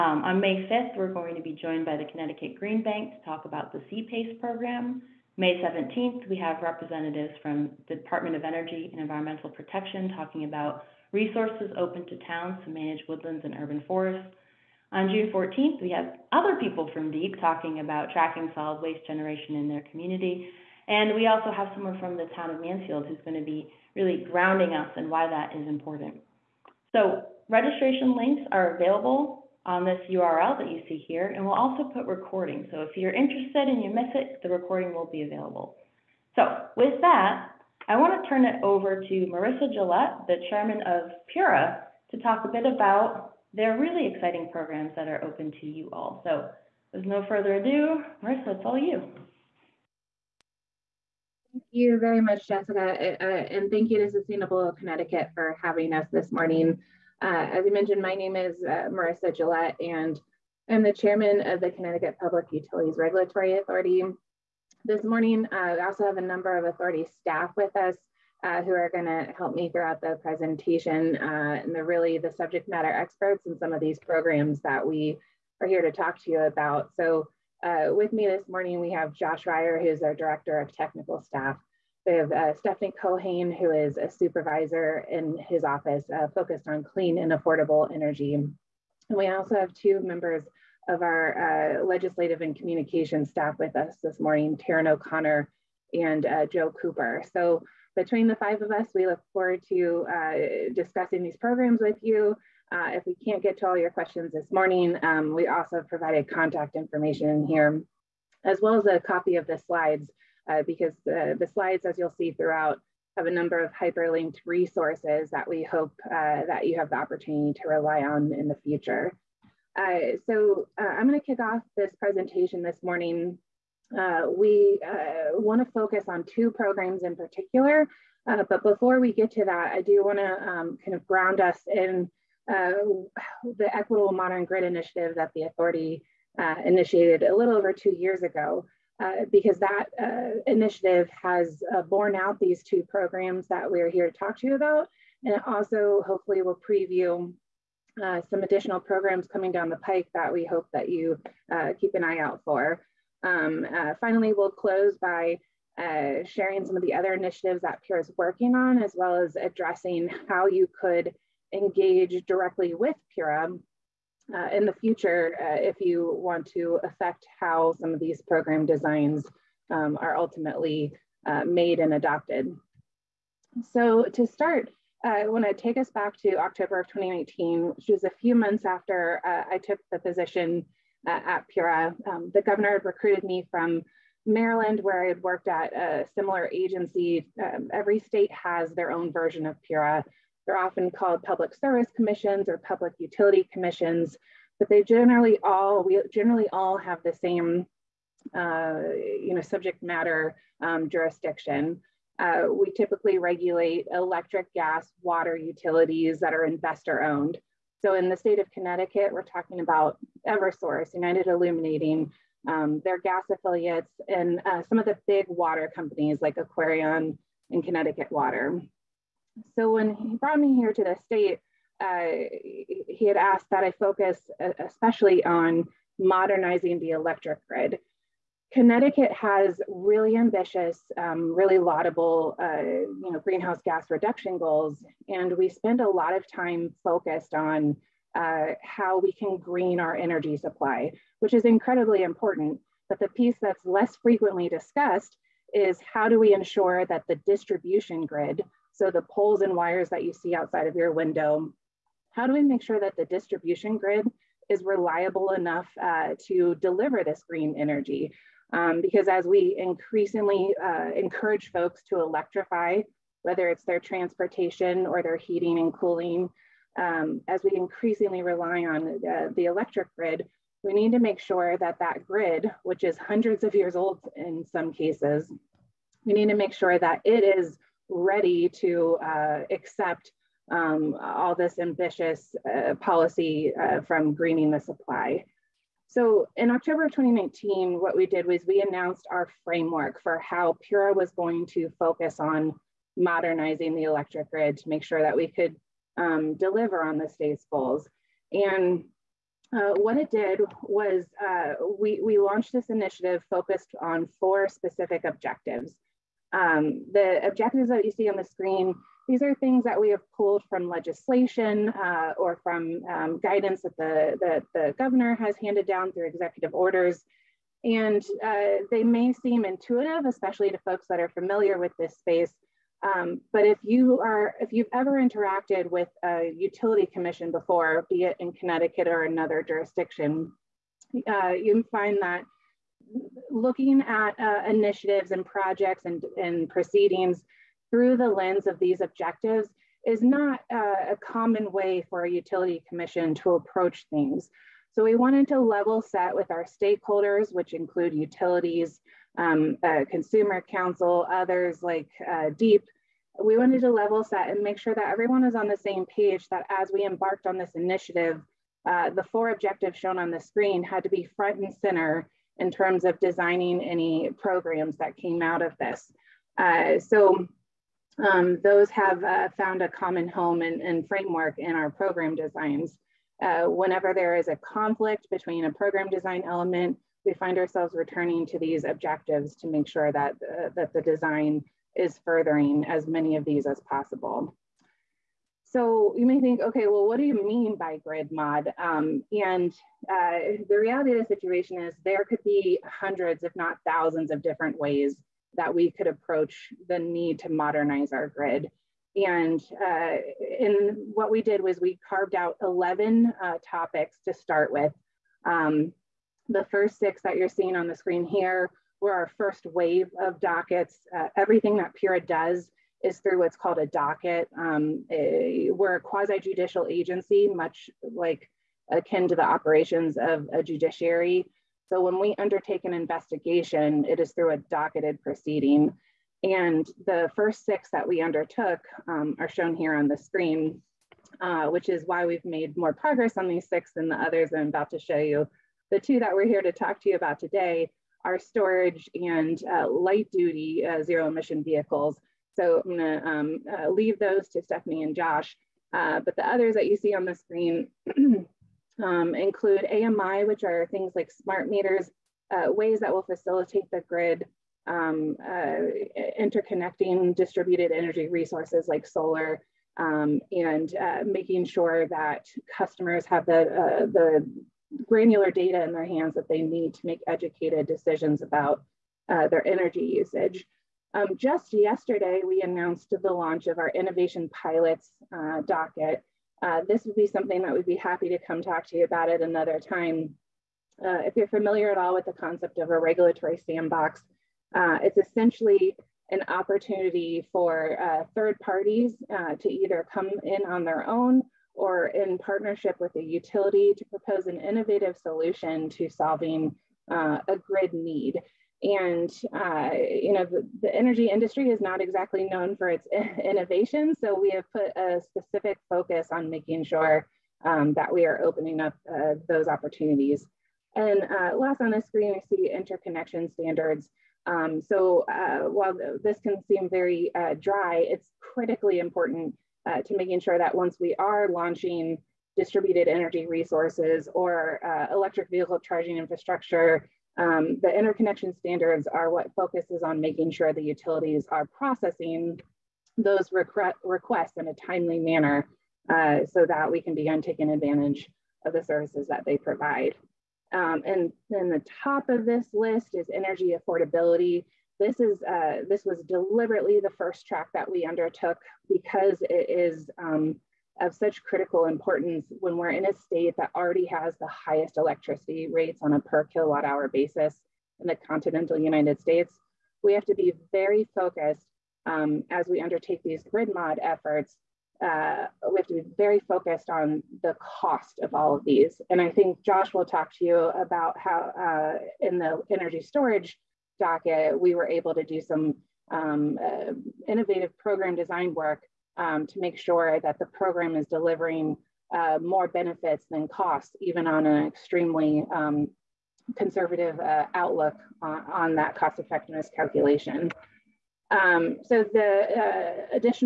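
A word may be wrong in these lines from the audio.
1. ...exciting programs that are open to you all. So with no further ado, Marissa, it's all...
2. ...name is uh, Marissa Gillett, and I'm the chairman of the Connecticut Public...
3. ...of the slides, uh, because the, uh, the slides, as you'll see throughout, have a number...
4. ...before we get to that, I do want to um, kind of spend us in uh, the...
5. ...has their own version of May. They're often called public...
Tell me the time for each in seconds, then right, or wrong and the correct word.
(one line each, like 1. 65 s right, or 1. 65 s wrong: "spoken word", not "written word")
1. 44 s right
2. 58 s right
3. 109 s right
4. 128 s wrong: "ground", not "spend"
5. 188 s wrong: "Pura", not "May".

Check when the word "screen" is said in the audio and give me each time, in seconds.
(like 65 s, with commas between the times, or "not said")
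308 s, 360 s, 407 s, 429 s, 447 s, 511 s.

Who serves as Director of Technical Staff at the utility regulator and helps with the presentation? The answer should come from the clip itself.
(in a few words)
Josh Ryer.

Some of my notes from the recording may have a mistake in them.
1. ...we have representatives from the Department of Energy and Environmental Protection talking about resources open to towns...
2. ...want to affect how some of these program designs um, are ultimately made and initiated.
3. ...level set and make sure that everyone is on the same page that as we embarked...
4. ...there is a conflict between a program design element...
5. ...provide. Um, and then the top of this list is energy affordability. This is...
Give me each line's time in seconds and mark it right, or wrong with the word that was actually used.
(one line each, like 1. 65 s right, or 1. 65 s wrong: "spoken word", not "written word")
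1. 6 s right
2. 166 s wrong: "adopted", not "initiated"
3. 353 s right
4. 373 s right
5. 539 s right.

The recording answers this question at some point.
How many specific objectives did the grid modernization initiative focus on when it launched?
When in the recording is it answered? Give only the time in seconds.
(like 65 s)
304 s.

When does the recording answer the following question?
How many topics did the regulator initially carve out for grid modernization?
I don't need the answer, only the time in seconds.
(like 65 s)
402 s.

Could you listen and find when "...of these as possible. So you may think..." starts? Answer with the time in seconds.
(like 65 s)
383 s.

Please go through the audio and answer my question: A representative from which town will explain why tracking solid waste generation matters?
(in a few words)
Mansfield.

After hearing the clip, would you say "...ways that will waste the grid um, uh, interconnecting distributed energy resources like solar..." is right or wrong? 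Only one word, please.
wrong.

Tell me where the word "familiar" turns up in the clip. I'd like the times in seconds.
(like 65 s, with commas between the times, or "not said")
321 s, 481 s.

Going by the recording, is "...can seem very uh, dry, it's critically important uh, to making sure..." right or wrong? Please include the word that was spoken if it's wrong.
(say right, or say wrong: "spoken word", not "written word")
right.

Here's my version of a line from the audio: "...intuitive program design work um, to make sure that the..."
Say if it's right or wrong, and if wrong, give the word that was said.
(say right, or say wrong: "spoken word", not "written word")
wrong: "innovative", not "intuitive".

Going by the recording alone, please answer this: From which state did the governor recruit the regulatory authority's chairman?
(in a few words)
Maryland.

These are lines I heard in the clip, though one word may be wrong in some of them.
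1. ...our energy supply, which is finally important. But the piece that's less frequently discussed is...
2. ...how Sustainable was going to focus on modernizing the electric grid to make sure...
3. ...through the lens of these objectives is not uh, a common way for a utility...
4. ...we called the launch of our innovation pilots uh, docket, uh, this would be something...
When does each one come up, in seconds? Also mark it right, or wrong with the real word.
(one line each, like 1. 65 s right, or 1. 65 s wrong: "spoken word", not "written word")
1. 239 s wrong: "incredibly", not "finally"
2. 290 s wrong: "Pura", not "Sustainable"
3. 337 s right
4. 472 s wrong: "announced", not "called".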